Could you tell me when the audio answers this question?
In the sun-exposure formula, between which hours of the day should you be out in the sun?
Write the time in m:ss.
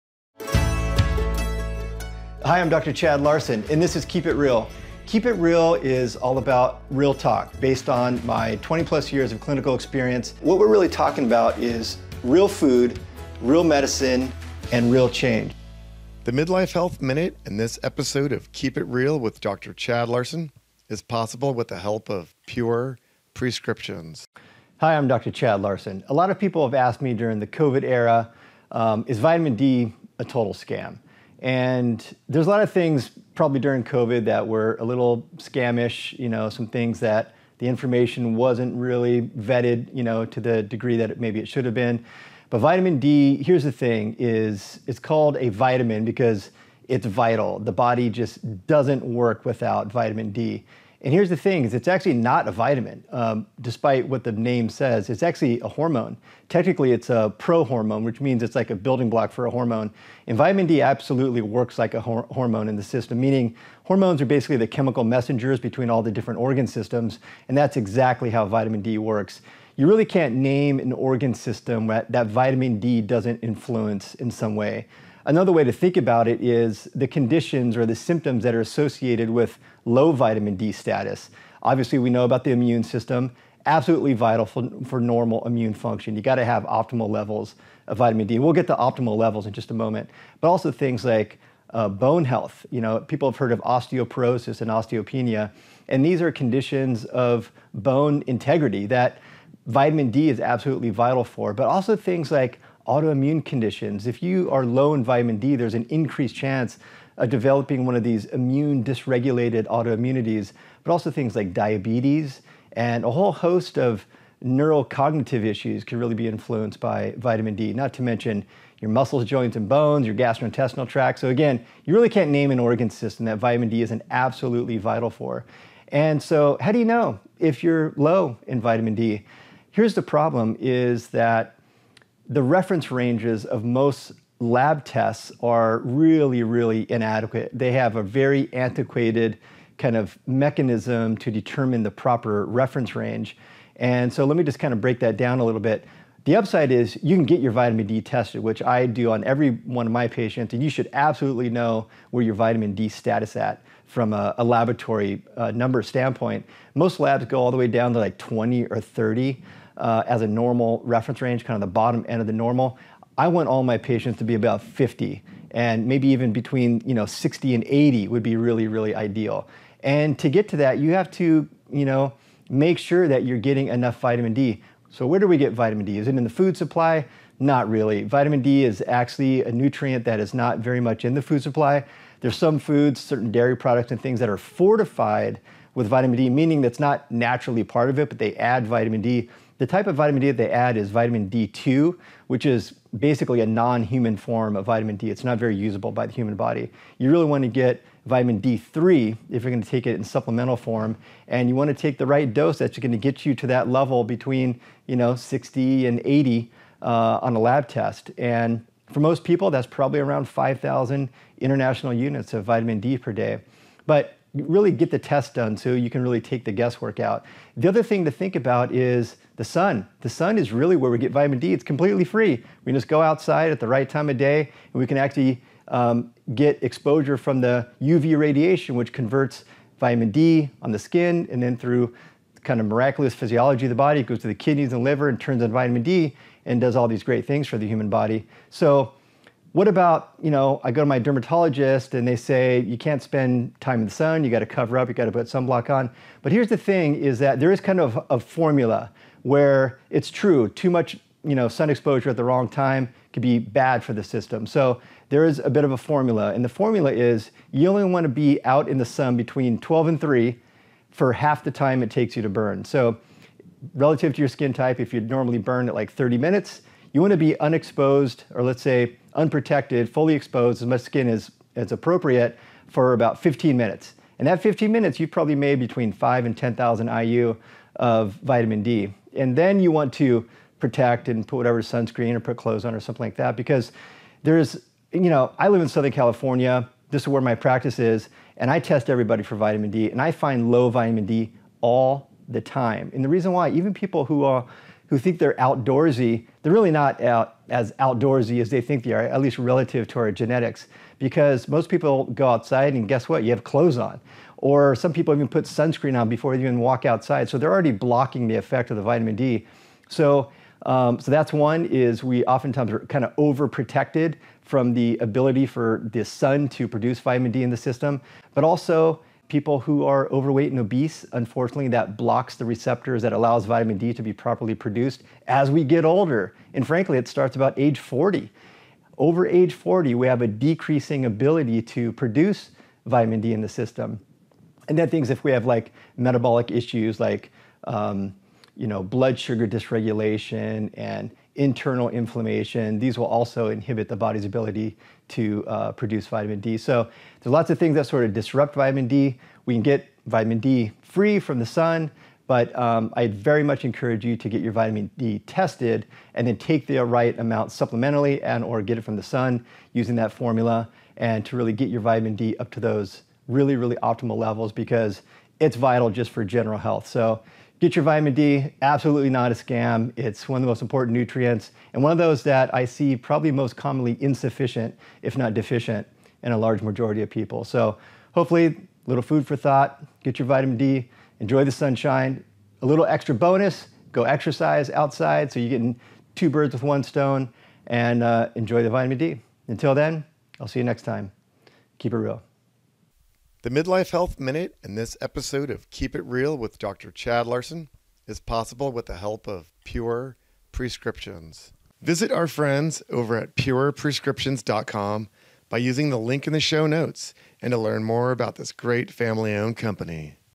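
4:19.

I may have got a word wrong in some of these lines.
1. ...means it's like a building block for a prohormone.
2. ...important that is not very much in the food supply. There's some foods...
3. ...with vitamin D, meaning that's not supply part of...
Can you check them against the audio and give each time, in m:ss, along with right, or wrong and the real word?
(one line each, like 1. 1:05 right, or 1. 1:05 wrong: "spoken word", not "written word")
1. 0:58 wrong: "hormone", not "prohormone"
2. 2:59 wrong: "nutrient", not "important"
3. 3:05 wrong: "naturally", not "supply".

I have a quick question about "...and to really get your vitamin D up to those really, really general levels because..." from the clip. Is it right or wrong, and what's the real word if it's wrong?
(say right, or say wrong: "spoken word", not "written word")
wrong: "optimal", not "general".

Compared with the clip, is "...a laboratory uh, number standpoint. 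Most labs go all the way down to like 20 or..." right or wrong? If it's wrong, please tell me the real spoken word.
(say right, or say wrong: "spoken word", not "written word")
right.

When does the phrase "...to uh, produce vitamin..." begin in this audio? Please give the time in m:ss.
5:45.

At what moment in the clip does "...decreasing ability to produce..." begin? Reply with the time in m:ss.
5:30.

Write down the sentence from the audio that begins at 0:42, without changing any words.
But vitamin D, here's the thing, is it's called a vitamin because it's vital.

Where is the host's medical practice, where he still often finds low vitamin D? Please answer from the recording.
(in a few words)
Southern California.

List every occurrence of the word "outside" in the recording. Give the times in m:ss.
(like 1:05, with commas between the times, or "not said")
3:43, 5:02, 5:06, 6:24.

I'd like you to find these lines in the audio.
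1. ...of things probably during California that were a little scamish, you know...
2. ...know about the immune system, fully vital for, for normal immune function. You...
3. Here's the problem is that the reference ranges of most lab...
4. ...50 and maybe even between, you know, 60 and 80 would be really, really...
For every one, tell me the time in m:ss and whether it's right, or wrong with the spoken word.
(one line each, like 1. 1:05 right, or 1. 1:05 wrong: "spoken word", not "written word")
1. 0:32 wrong: "COVID", not "California"
2. 1:22 wrong: "absolutely", not "fully"
3. 2:09 right
4. 2:44 right.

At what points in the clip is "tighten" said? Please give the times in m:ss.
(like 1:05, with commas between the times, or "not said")
not said.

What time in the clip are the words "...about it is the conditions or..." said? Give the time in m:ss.
1:15.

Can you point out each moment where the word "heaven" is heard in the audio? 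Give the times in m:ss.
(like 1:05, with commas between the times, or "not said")
not said.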